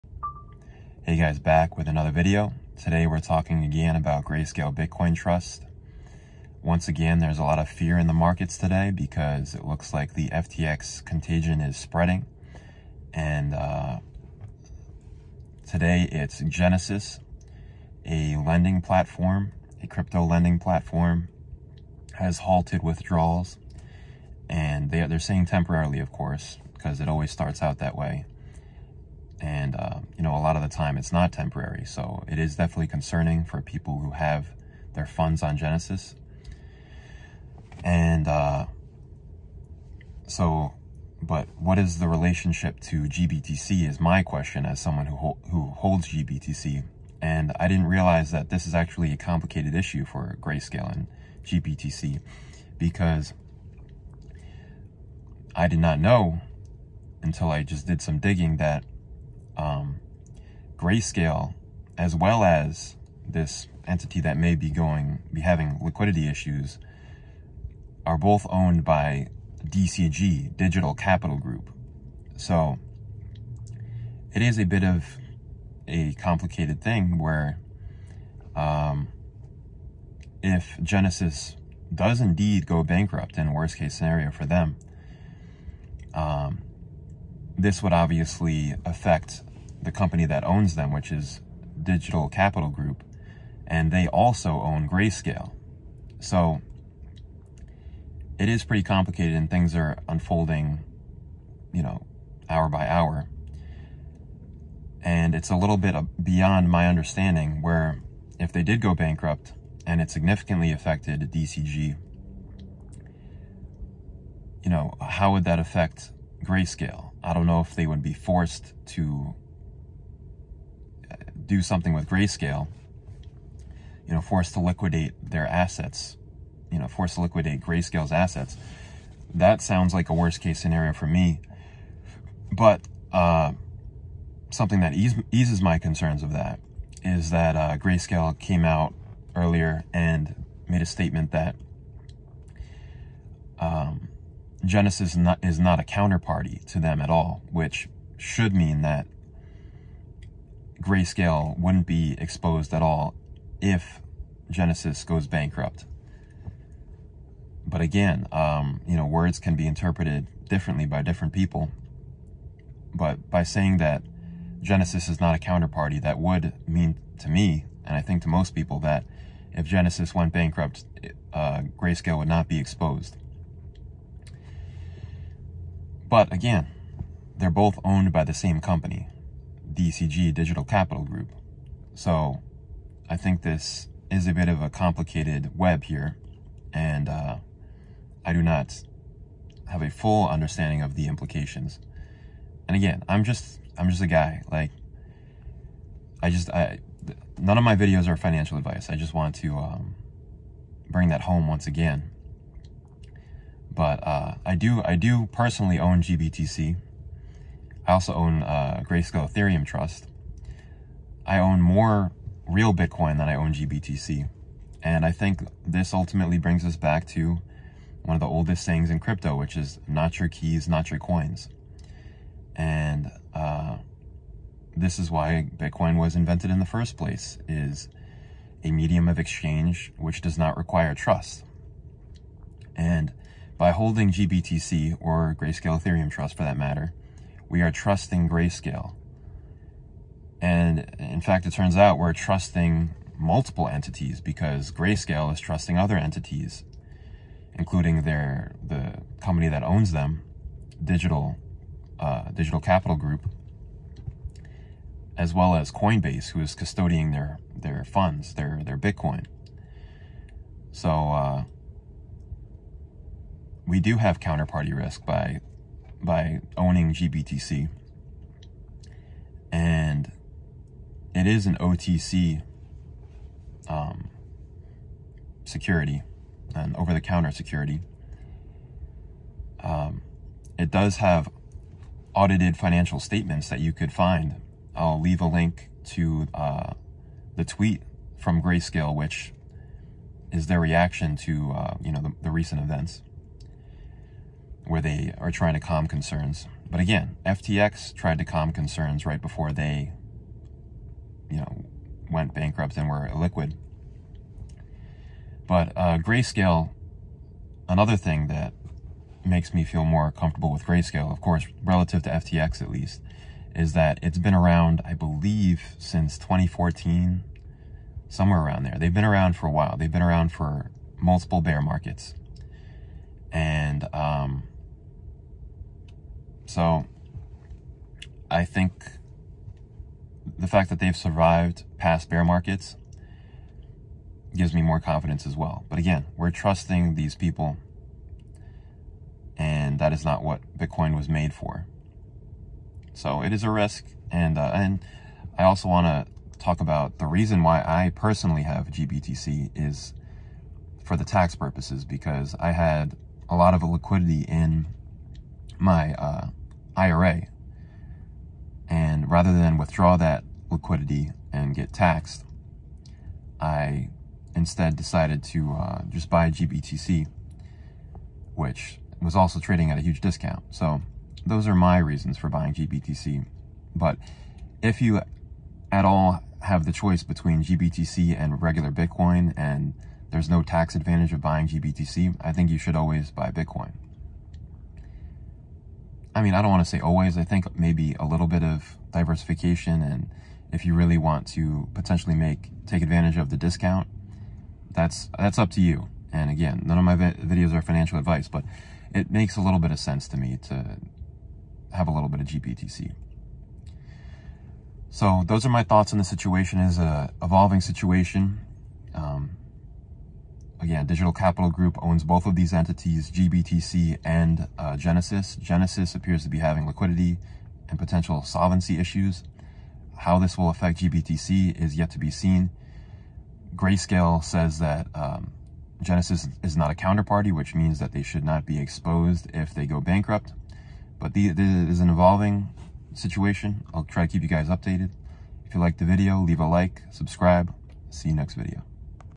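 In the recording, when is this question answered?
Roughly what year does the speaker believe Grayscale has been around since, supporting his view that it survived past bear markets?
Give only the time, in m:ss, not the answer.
5:16.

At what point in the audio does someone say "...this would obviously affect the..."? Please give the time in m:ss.
1:27.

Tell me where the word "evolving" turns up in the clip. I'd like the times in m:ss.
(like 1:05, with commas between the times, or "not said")
6:47, 7:11.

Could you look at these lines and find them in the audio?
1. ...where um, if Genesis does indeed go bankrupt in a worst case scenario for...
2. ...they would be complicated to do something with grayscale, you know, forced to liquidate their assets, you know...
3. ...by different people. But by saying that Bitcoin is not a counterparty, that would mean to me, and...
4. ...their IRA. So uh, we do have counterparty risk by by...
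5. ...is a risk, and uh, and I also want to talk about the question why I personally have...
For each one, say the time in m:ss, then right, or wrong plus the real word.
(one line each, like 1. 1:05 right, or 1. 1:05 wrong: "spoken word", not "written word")
1. 1:17 right
2. 1:57 wrong: "forced", not "complicated"
3. 2:40 wrong: "Genesis", not "Bitcoin"
4. 4:18 wrong: "Bitcoin", not "IRA"
5. 5:43 wrong: "reason", not "question".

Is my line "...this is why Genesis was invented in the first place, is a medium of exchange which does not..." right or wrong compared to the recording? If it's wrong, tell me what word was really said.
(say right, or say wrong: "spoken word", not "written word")
wrong: "Bitcoin", not "Genesis".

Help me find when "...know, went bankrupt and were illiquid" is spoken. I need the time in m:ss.
5:01.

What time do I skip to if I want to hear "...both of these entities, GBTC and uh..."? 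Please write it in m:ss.
6:52.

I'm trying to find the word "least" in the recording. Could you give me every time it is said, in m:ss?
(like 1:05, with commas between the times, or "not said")
5:12.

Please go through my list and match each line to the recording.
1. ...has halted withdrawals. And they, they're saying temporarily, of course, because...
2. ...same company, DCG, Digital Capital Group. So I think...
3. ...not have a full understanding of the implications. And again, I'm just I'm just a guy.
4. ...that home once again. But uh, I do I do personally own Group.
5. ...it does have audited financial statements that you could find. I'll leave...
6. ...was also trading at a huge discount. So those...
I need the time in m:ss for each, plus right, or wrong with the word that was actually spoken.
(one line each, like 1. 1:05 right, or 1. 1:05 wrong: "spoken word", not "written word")
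1. 0:22 right
2. 2:58 right
3. 3:08 right
4. 3:21 wrong: "GBTC", not "Group"
5. 4:40 right
6. 6:09 right.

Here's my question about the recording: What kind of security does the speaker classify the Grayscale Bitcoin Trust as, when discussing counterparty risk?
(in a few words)
over-the-counter security.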